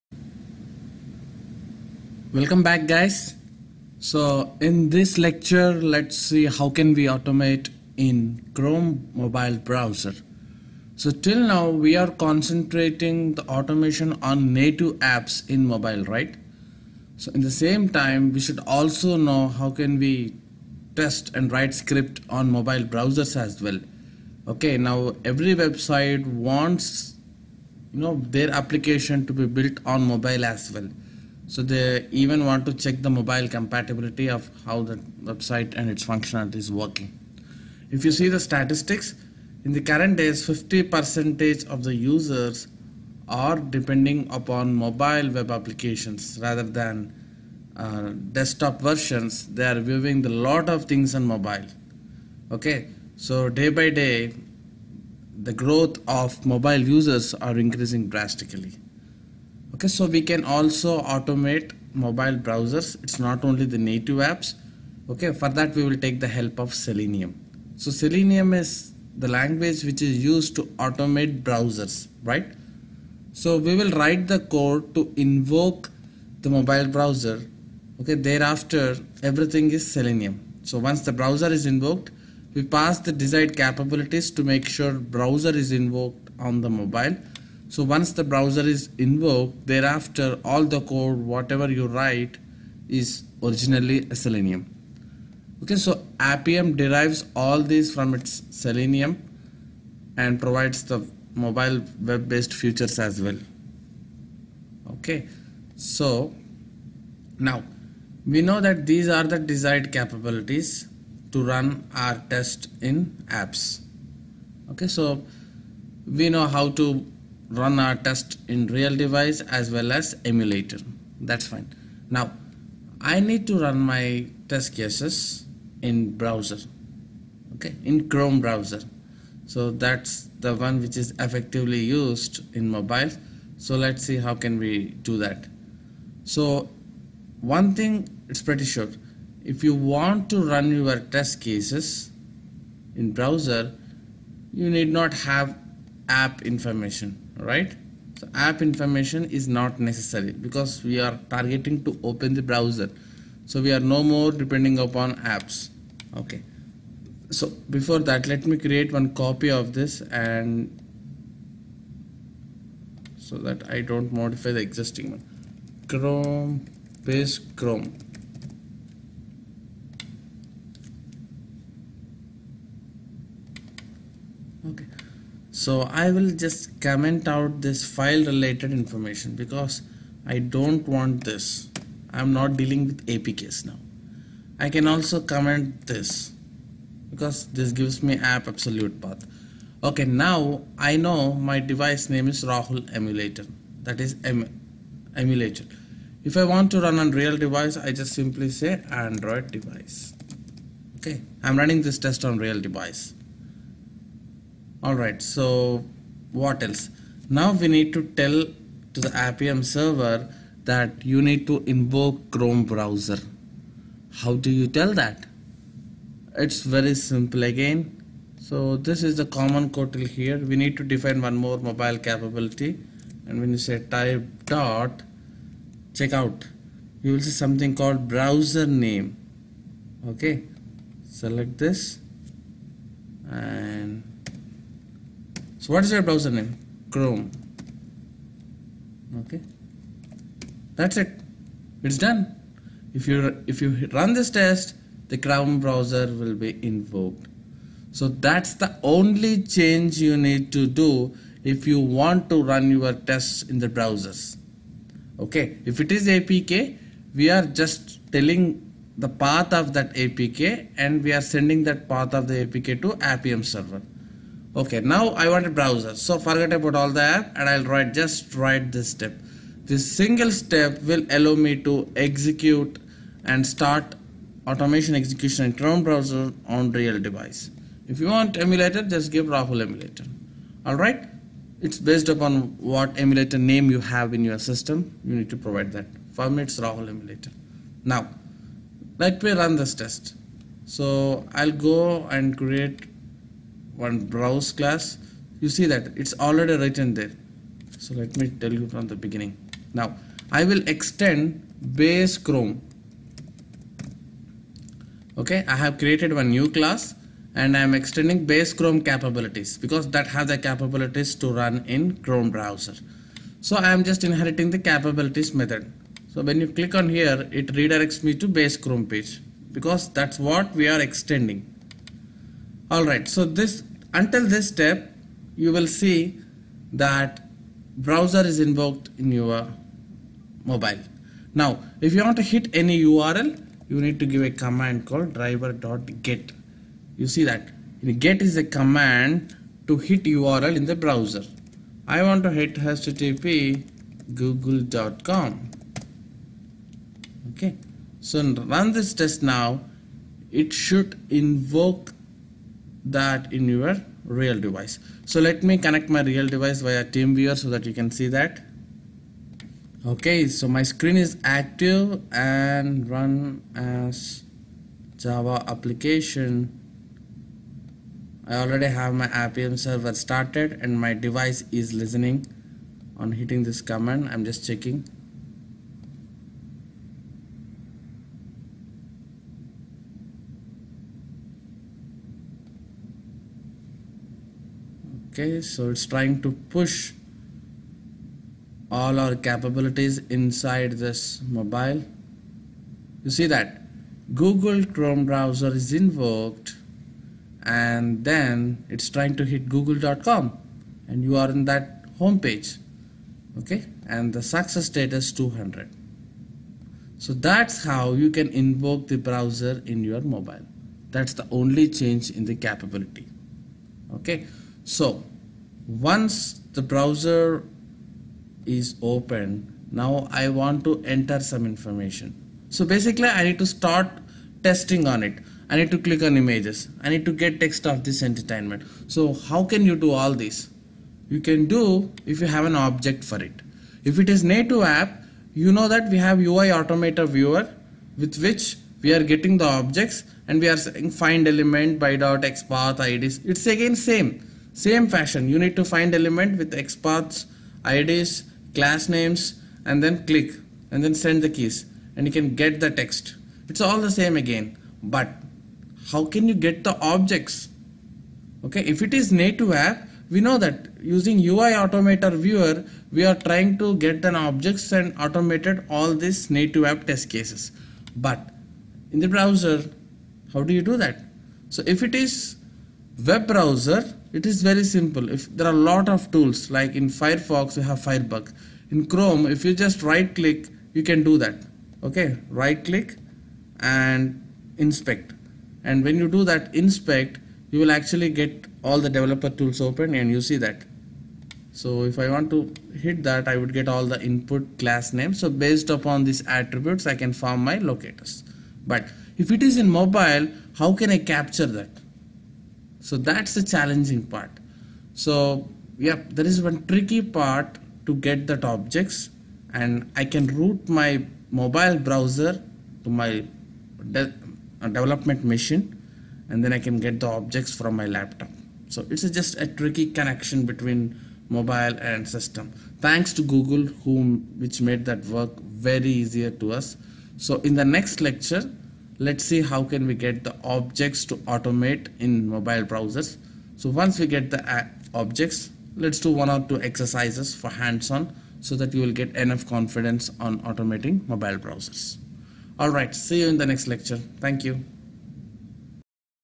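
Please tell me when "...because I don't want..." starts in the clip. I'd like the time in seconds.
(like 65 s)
179 s.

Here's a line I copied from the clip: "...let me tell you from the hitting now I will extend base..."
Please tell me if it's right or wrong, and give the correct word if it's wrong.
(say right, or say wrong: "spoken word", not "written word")
wrong: "beginning", not "hitting".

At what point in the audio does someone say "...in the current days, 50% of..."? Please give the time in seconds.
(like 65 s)
39 s.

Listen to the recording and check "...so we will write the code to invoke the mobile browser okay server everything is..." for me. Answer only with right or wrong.
wrong.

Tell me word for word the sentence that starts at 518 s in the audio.
So it's just a tricky connection between mobile and system.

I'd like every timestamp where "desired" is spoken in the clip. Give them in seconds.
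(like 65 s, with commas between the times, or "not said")
83 s, 109 s.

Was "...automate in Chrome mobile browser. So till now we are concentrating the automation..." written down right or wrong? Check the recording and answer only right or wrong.
right.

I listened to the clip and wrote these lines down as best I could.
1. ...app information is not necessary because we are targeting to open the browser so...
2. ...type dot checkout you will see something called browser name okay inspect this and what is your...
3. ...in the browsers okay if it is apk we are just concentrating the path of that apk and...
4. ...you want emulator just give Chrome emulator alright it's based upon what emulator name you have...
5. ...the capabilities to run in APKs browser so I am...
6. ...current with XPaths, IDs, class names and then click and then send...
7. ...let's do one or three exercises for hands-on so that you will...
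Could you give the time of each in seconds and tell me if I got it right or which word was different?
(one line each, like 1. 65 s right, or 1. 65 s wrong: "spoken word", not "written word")
1. 148 s right
2. 223 s wrong: "select", not "inspect"
3. 253 s wrong: "telling", not "concentrating"
4. 278 s wrong: "Rahul", not "Chrome"
5. 310 s wrong: "Chrome", not "APKs"
6. 445 s wrong: "element", not "current"
7. 535 s wrong: "two", not "three".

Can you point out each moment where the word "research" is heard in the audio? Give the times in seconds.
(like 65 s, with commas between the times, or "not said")
not said.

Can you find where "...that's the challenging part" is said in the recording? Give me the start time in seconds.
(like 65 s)
502 s.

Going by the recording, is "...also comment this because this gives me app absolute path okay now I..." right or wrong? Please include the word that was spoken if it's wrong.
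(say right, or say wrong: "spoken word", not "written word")
right.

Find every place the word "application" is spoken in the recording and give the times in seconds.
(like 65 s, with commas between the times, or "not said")
28 s, 45 s, 365 s.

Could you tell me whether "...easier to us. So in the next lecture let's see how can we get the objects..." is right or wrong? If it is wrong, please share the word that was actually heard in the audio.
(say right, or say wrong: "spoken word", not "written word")
right.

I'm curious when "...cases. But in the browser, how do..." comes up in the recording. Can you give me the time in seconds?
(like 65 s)
467 s.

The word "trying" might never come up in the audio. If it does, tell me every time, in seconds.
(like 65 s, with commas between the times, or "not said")
385 s, 398 s, 463 s.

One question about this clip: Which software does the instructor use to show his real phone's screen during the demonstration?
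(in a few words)
TeamViewer.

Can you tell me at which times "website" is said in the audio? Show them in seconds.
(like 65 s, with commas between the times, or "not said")
25 s, 35 s.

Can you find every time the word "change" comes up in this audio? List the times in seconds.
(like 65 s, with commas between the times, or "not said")
249 s, 411 s.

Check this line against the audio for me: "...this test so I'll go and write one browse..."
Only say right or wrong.
wrong.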